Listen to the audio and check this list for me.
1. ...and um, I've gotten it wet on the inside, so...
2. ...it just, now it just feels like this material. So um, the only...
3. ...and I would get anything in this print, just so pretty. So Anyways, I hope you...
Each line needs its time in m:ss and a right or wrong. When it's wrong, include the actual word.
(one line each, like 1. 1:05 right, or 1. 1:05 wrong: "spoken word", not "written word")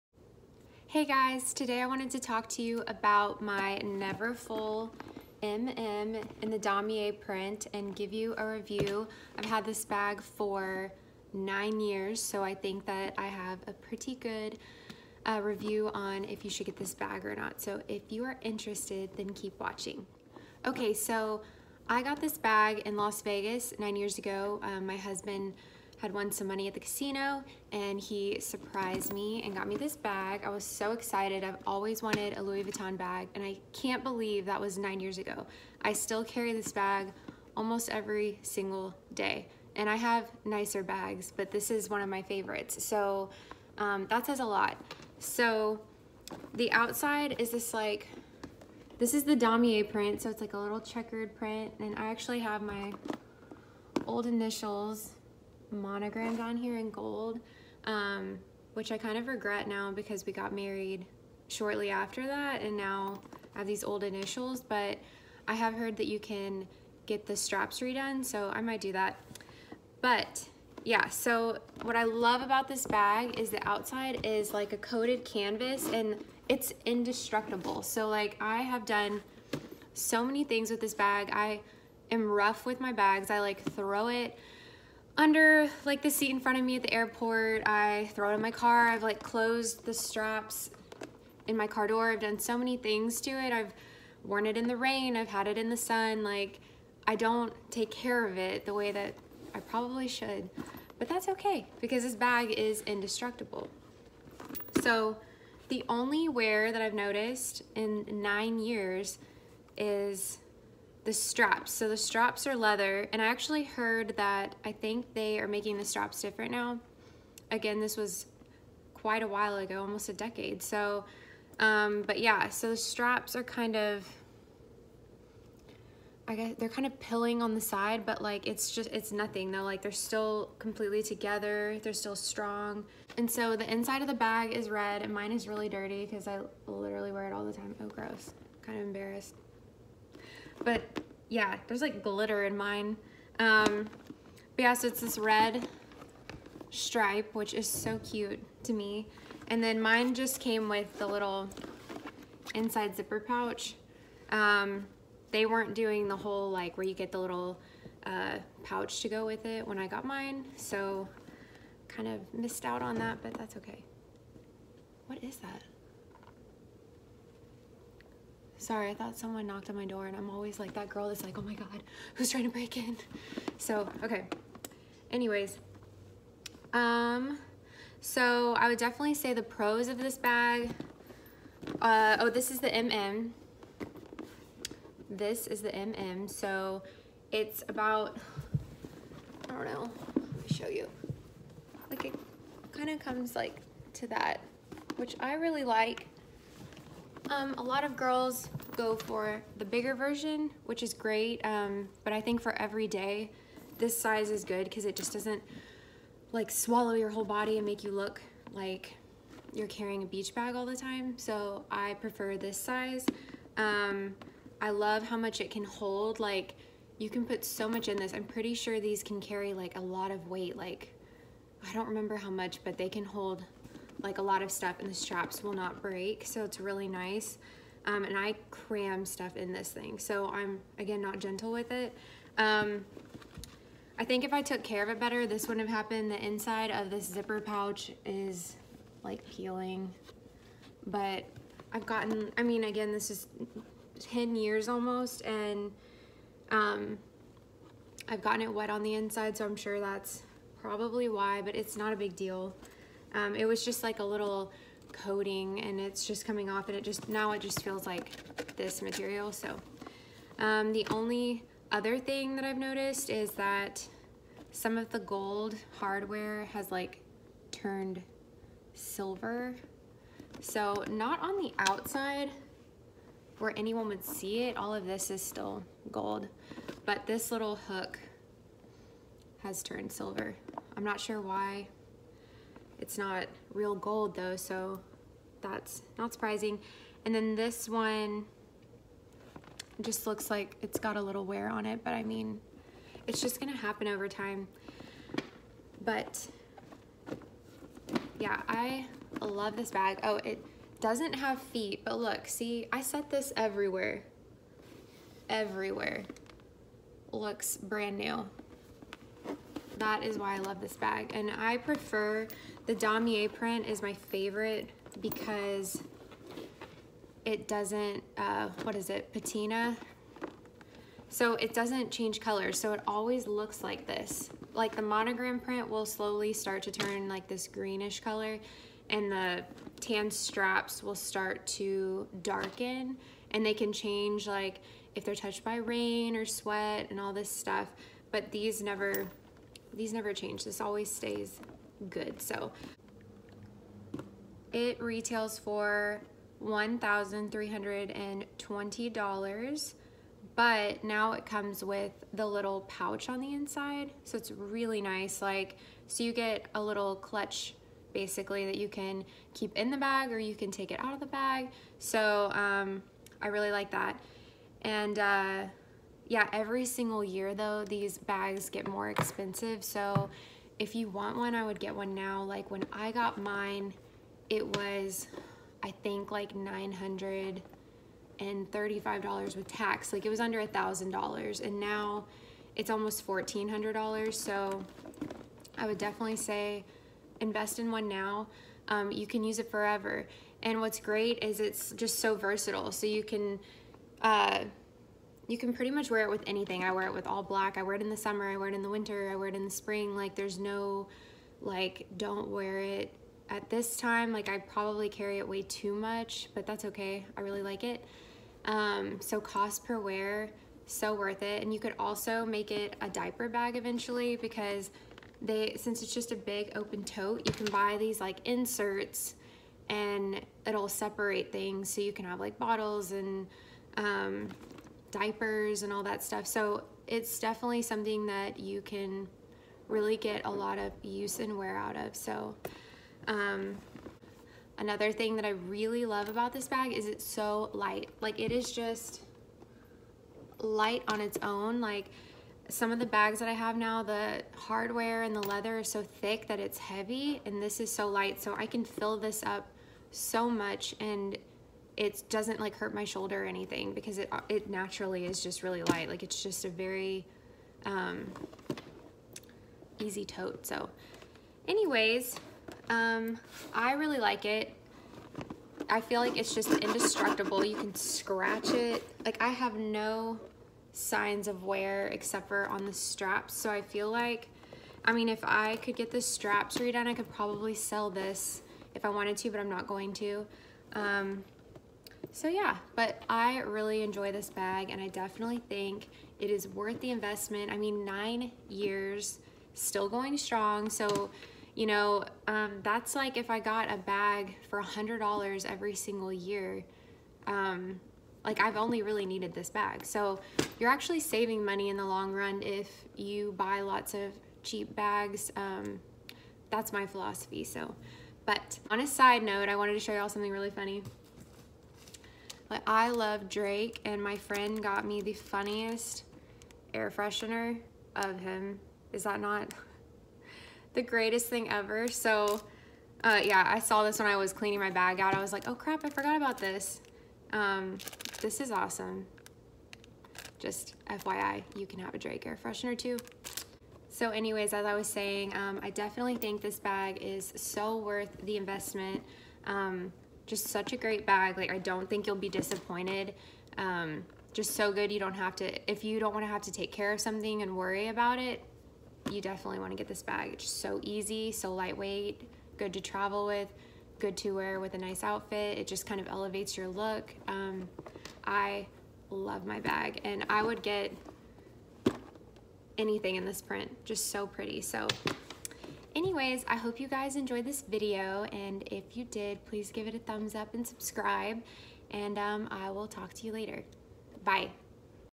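1. 4:05 right
2. 4:16 right
3. 9:20 right.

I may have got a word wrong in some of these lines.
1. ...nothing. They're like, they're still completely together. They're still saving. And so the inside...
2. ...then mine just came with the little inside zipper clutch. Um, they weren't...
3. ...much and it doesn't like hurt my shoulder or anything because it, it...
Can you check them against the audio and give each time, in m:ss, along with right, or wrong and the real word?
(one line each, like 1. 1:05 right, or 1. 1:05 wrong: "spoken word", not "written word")
1. 2:09 wrong: "strong", not "saving"
2. 2:29 wrong: "pouch", not "clutch"
3. 7:30 right.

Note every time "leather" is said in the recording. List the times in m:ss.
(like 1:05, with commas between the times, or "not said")
1:52, 7:25.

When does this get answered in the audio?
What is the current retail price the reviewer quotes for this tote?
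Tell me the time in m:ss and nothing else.
5:46.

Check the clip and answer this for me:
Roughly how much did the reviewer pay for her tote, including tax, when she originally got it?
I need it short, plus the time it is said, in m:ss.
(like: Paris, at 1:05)
$935, at 6:16.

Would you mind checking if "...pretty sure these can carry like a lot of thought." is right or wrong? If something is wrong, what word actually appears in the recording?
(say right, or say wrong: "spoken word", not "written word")
wrong: "weight", not "thought".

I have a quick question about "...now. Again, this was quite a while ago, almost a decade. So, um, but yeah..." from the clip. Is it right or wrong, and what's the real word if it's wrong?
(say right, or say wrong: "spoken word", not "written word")
right.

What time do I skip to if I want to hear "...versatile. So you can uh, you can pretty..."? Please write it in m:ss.
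6:32.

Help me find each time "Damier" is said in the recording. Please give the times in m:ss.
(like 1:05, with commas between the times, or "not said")
0:06, 0:49, 5:12.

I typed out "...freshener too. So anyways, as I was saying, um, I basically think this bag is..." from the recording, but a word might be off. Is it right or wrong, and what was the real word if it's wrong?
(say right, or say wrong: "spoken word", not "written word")
wrong: "definitely", not "basically".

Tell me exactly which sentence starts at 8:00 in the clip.
Um, so yeah, but I really enjoy this bag and I definitely think it is worth the investment.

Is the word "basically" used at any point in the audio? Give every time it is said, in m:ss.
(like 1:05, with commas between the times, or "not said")
5:57.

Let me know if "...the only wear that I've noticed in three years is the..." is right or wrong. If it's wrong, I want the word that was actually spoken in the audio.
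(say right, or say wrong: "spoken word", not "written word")
wrong: "nine", not "three".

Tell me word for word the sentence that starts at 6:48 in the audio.
Um, so cost per wear, so worth it.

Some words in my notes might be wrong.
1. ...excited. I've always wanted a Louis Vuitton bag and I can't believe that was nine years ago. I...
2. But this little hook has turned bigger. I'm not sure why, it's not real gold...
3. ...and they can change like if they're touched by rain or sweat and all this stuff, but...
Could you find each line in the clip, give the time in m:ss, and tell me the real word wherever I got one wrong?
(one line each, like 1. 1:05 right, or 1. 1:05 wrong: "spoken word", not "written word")
1. 0:30 right
2. 4:36 wrong: "silver", not "bigger"
3. 5:33 right.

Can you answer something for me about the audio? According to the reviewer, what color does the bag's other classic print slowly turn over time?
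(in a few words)
Greenish.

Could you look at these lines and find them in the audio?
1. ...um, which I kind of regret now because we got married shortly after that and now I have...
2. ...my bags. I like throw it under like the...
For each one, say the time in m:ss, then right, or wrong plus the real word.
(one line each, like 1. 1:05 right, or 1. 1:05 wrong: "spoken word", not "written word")
1. 0:57 right
2. 1:22 right.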